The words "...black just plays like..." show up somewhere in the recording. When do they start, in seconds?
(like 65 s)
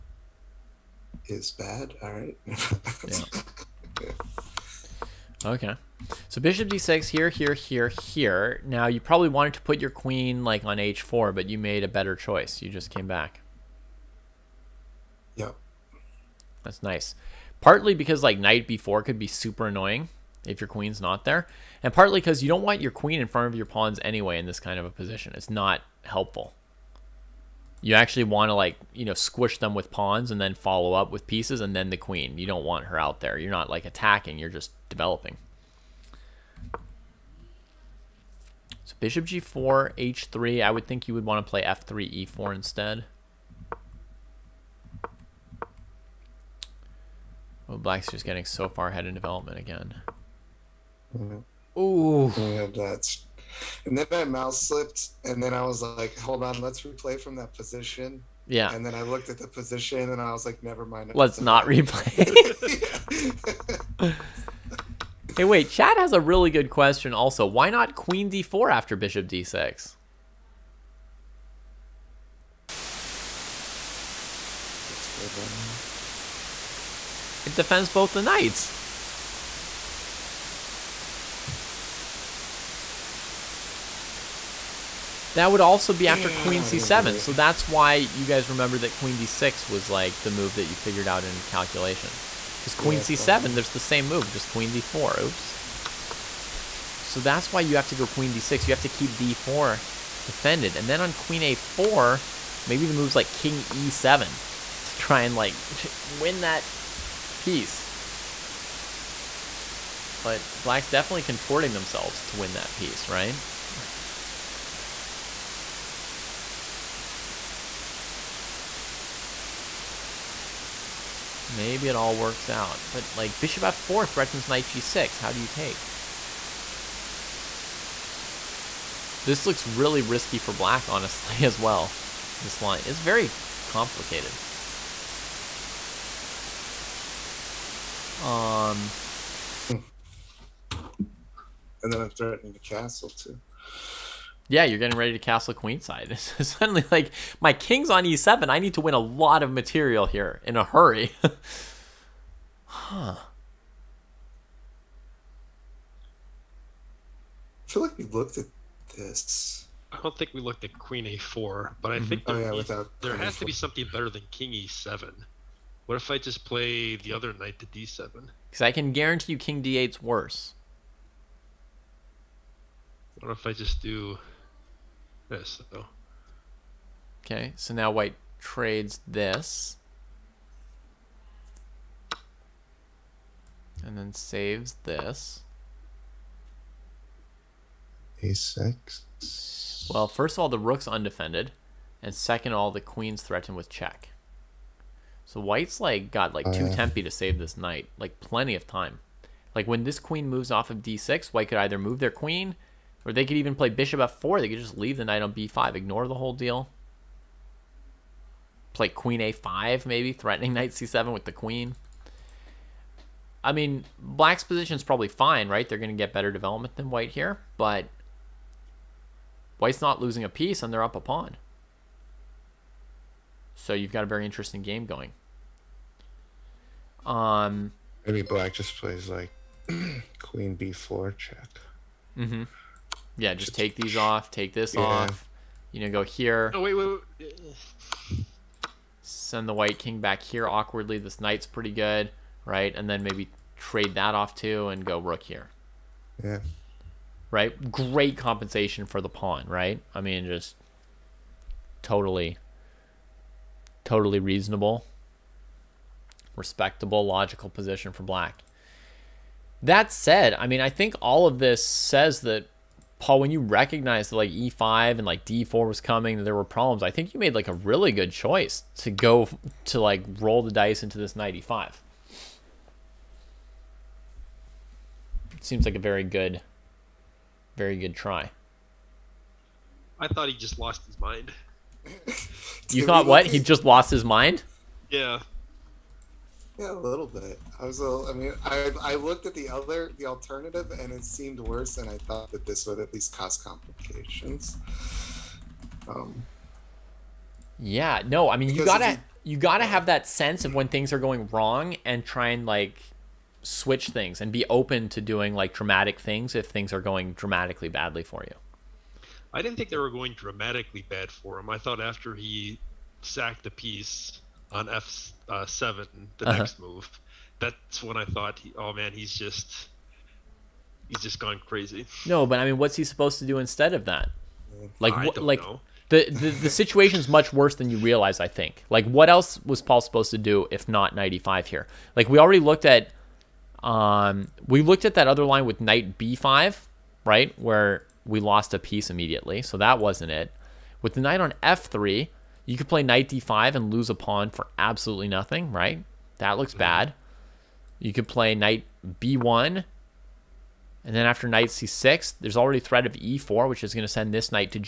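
228 s.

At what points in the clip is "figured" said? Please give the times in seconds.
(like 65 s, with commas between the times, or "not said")
90 s.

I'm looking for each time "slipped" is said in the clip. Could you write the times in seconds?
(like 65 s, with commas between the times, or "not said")
54 s.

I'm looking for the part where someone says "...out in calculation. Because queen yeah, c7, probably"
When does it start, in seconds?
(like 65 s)
91 s.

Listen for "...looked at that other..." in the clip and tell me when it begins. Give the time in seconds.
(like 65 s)
334 s.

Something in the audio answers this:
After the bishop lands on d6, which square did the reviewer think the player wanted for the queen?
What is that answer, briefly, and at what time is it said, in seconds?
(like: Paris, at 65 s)
h4, at 10 s.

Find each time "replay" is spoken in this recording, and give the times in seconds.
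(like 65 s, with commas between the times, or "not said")
56 s, 61 s.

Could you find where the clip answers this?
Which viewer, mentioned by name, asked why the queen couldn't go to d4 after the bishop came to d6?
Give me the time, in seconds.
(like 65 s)
65 s.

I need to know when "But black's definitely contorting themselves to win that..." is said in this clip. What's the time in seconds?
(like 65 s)
110 s.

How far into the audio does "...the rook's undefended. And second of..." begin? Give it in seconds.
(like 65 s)
190 s.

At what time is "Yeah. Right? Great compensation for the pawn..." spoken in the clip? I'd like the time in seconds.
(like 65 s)
246 s.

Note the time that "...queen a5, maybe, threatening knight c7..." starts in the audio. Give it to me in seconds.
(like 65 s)
208 s.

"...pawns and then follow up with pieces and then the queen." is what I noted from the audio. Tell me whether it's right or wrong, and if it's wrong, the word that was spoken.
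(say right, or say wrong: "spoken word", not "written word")
right.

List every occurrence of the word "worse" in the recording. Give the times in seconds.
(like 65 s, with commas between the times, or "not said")
170 s, 291 s, 327 s.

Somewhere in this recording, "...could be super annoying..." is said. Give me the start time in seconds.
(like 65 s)
19 s.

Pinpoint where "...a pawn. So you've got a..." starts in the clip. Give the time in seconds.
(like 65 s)
220 s.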